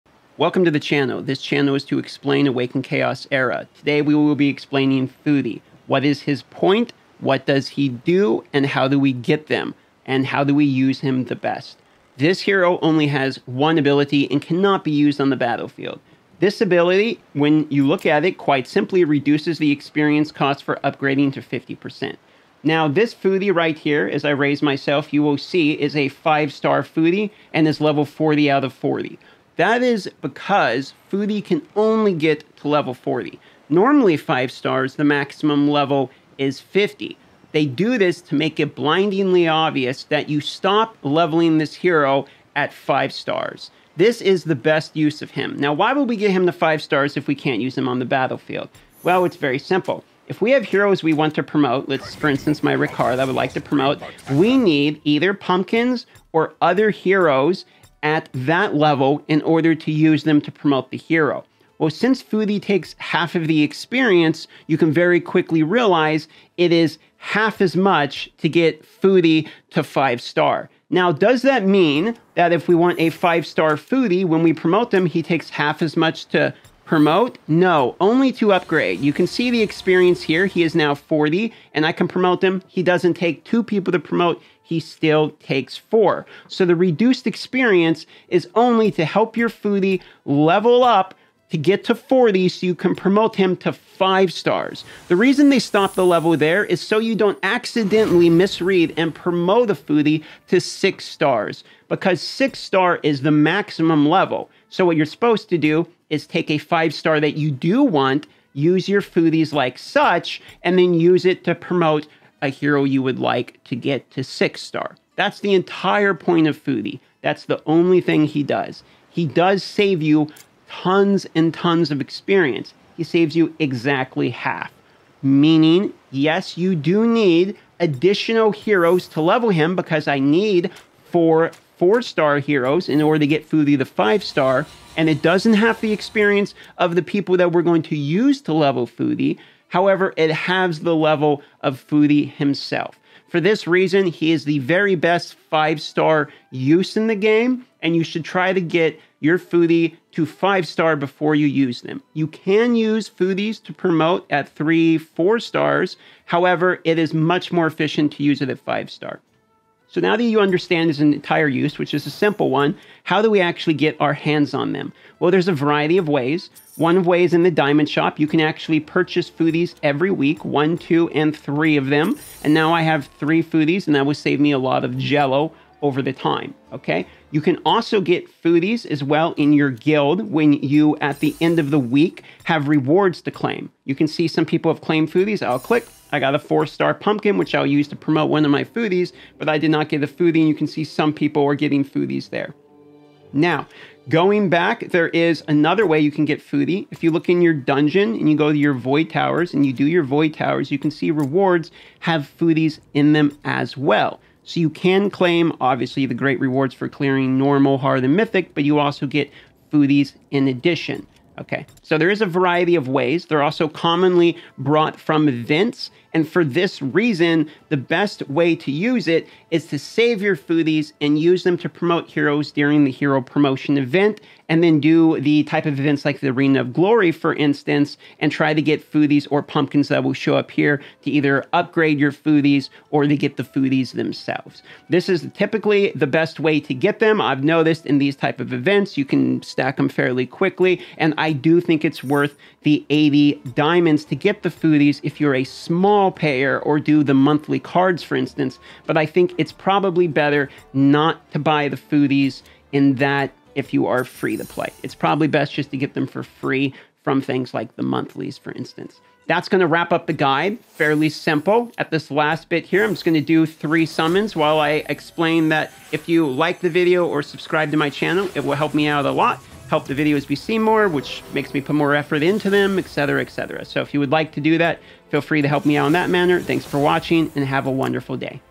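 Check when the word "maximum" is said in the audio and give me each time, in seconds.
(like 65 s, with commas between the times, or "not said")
35 s, 103 s.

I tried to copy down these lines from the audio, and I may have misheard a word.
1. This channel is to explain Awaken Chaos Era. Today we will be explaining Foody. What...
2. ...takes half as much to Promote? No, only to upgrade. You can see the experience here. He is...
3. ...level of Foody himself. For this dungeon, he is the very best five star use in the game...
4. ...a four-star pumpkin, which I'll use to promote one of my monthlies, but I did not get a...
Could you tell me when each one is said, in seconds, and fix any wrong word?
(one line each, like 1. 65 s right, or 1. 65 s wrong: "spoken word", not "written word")
1. 1 s right
2. 75 s right
3. 140 s wrong: "reason", not "dungeon"
4. 186 s wrong: "foodies", not "monthlies".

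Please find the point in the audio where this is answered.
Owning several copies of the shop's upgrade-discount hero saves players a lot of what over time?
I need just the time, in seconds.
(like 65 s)
174 s.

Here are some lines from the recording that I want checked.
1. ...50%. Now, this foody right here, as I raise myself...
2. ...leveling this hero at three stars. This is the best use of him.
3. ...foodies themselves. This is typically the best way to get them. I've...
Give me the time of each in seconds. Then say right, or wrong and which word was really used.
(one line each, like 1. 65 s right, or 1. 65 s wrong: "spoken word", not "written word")
1. 21 s right
2. 41 s wrong: "five", not "three"
3. 233 s right.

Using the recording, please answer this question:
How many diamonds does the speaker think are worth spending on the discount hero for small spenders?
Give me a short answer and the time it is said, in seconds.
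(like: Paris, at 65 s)
80, at 242 s.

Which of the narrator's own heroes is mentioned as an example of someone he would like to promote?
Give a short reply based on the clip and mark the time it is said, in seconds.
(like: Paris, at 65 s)
Ricard, at 52 s.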